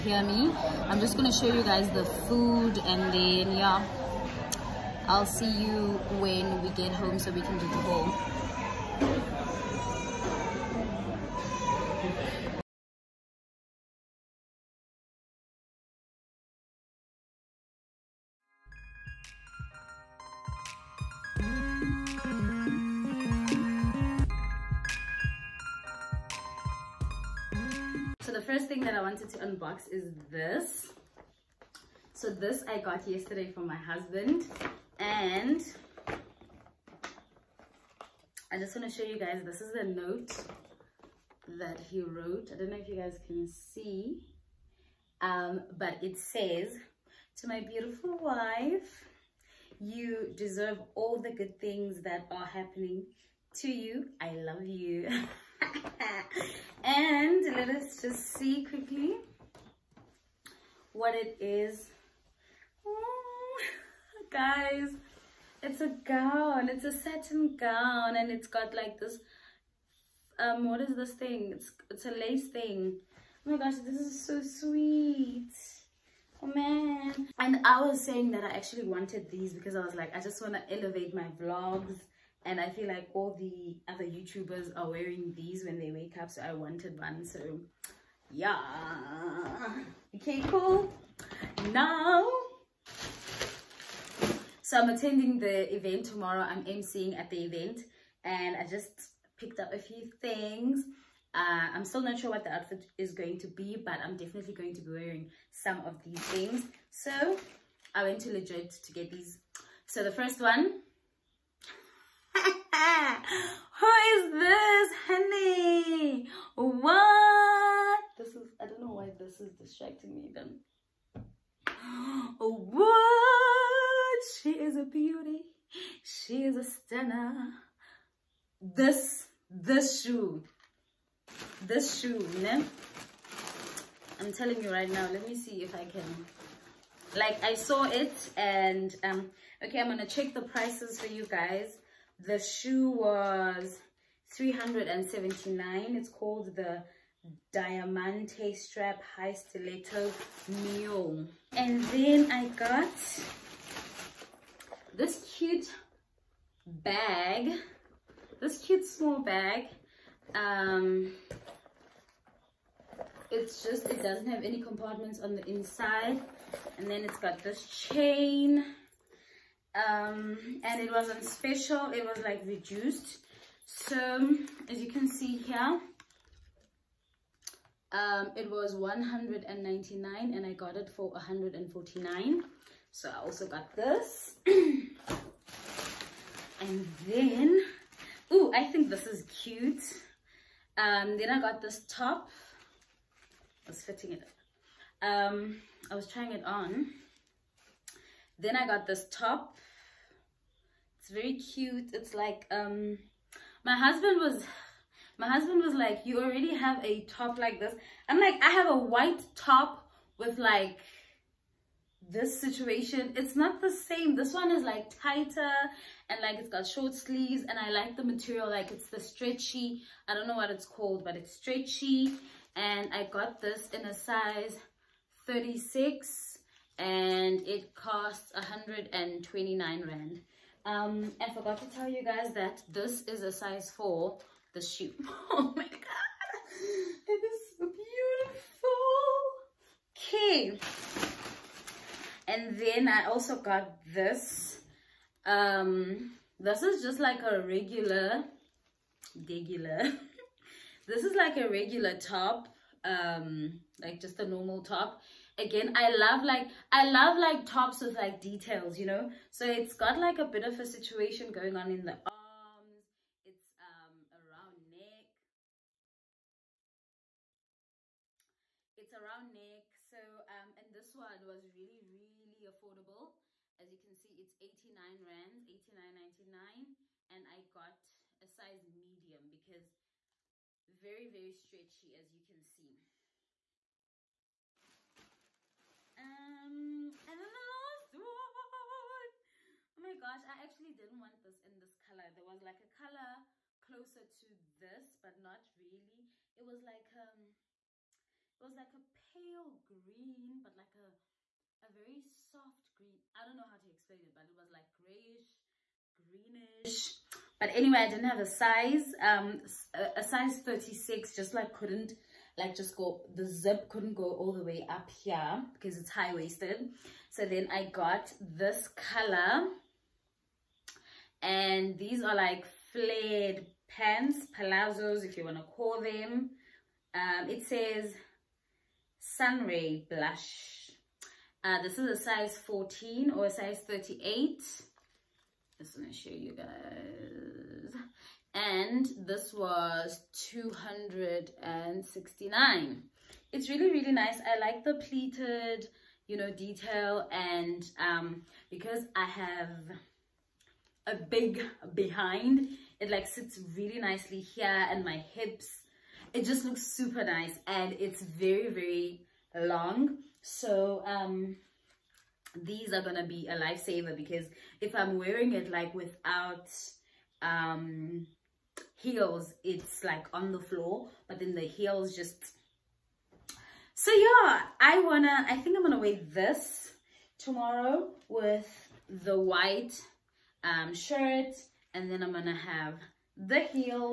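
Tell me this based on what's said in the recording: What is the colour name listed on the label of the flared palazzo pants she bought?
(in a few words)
sunray blush.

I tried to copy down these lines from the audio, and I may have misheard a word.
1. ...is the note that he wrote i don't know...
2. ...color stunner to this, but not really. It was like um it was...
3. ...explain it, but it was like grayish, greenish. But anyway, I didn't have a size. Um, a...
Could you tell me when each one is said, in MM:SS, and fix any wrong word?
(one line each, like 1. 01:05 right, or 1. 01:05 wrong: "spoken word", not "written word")
1. 00:39 right
2. 04:52 wrong: "closer", not "stunner"
3. 05:03 right.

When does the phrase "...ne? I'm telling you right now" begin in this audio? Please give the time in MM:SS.
02:12.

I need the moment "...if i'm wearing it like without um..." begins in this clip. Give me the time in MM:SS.
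06:04.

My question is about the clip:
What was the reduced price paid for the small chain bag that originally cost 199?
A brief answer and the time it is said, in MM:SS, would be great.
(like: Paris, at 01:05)
149, at 03:01.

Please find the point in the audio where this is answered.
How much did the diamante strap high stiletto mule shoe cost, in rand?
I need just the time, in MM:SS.
02:24.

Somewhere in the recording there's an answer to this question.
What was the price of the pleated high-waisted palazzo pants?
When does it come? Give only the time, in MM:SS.
05:40.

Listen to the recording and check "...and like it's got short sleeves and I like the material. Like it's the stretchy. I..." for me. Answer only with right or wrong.
right.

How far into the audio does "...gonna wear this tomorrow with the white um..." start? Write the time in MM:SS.
06:15.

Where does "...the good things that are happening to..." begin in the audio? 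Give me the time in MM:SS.
00:51.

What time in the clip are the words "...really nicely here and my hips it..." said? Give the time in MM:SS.
05:53.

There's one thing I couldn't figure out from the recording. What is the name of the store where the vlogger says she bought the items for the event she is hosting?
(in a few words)
Legit.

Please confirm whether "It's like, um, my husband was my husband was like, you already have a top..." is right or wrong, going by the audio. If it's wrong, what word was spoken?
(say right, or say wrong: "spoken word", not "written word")
right.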